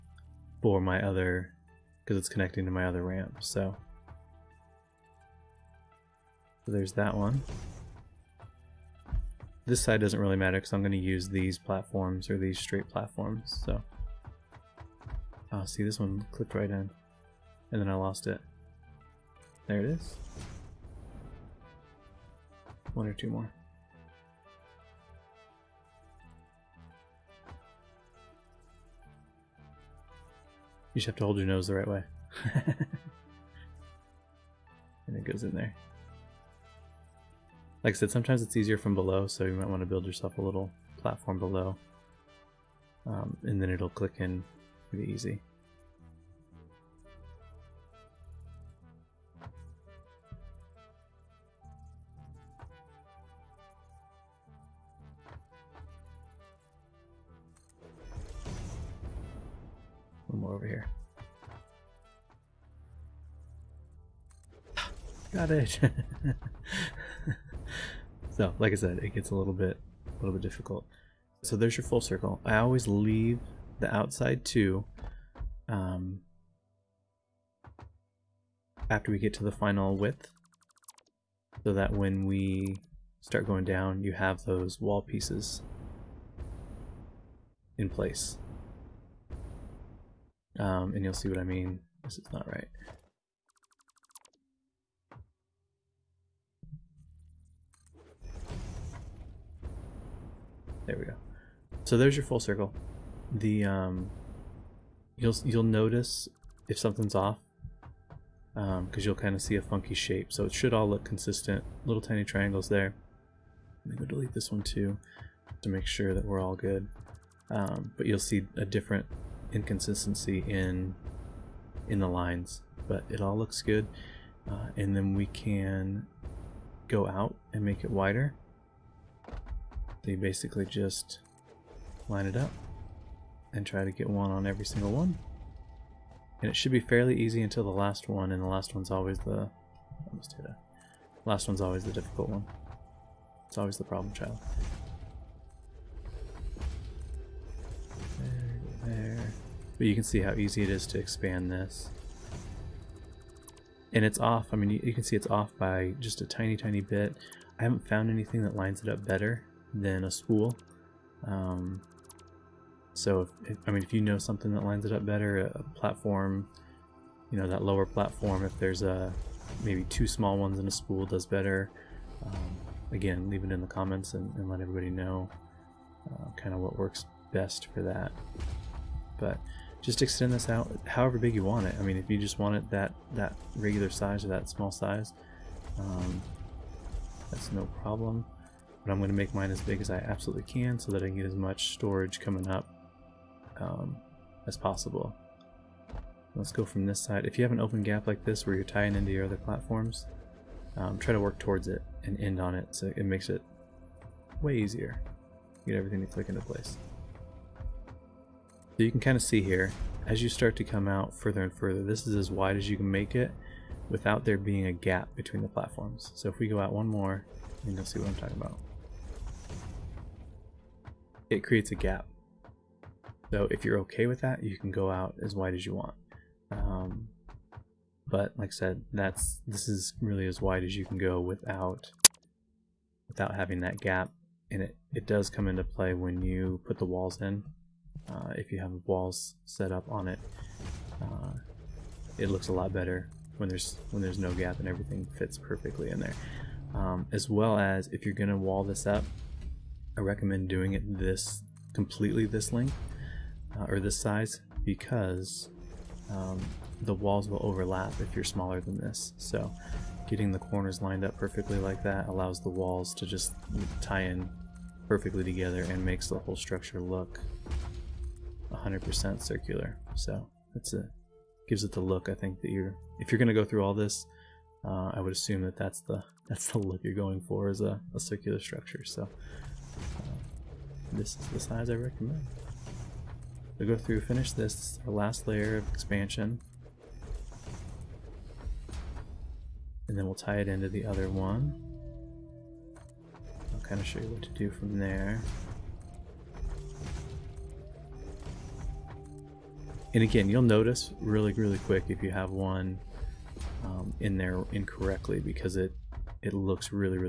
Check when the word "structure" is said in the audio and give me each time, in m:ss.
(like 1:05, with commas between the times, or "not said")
4:26, 4:38.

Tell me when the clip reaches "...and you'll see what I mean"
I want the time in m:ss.
1:30.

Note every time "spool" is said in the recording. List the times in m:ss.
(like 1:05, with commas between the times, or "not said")
2:40, 2:50.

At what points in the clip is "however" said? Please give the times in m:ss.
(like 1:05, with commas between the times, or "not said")
3:00.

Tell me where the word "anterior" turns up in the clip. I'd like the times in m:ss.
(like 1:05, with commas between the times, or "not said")
not said.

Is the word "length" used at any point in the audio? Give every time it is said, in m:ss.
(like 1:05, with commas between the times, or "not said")
4:12.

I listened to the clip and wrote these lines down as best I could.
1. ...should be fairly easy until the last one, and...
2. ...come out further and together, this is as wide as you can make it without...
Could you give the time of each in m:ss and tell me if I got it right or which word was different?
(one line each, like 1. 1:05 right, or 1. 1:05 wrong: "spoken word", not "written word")
1. 2:16 right
2. 3:30 wrong: "further", not "together".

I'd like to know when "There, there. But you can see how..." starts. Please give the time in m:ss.
2:28.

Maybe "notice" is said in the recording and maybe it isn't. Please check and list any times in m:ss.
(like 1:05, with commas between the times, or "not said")
1:45, 5:00.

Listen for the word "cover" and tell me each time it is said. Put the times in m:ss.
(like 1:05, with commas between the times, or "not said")
not said.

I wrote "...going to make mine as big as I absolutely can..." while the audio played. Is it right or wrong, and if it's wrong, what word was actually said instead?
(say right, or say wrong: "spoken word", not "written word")
right.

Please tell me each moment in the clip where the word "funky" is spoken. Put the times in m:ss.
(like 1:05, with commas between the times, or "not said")
1:49.